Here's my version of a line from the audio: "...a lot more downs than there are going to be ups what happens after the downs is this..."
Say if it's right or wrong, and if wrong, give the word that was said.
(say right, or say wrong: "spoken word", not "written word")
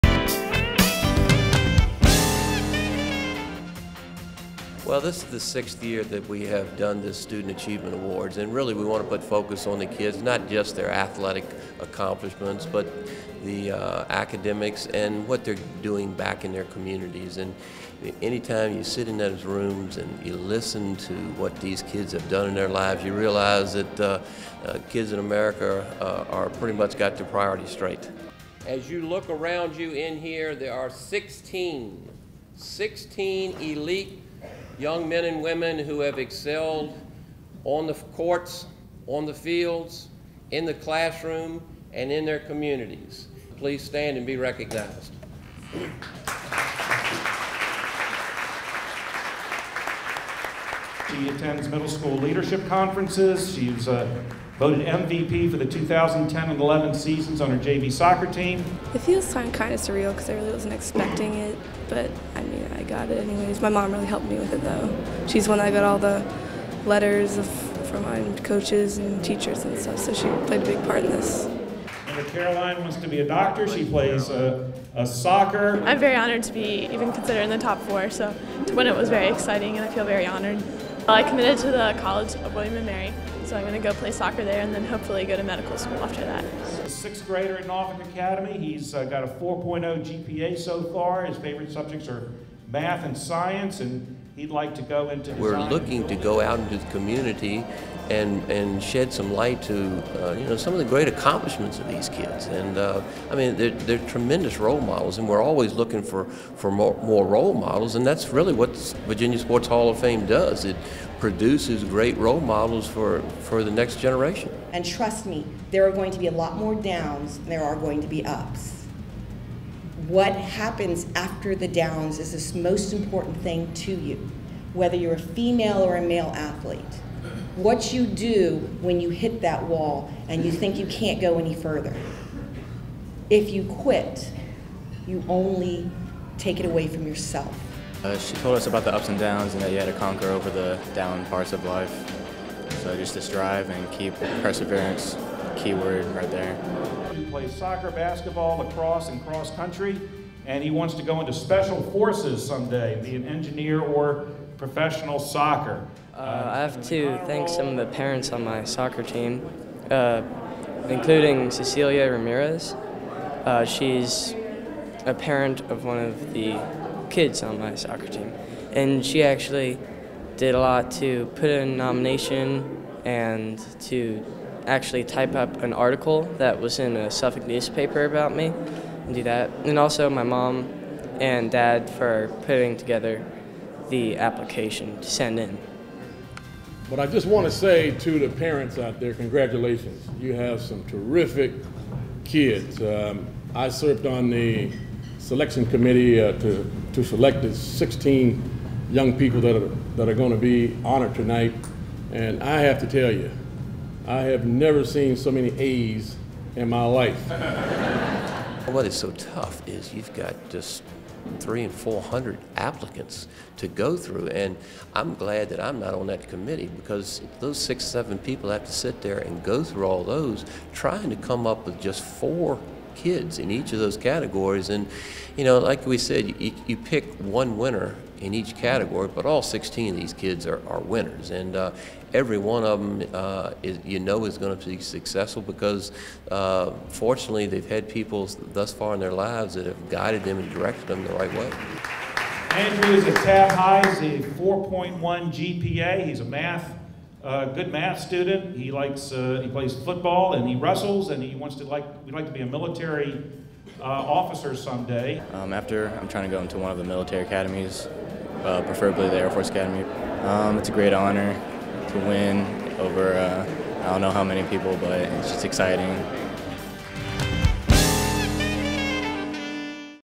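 right.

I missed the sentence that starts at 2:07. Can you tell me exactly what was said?
What you do when you hit that wall and you think you can't go any further.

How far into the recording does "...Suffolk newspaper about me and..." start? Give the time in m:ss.
2:57.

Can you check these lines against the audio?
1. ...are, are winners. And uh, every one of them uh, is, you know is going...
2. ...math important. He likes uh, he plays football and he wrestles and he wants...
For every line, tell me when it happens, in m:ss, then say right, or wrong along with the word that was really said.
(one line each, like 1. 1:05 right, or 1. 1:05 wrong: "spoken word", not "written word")
1. 3:50 right
2. 4:07 wrong: "student", not "important".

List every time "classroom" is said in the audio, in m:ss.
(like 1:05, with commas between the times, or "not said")
0:40.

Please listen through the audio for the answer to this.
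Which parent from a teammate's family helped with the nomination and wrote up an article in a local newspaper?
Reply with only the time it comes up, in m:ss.
2:41.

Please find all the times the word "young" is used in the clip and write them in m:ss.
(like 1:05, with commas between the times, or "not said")
0:34, 3:18.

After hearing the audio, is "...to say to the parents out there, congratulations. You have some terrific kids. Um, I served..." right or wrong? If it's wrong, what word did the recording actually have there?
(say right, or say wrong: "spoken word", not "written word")
right.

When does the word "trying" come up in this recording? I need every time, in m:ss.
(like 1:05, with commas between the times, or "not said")
3:40, 4:16.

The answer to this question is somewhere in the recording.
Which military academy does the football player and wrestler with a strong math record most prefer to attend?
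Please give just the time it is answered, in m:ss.
4:19.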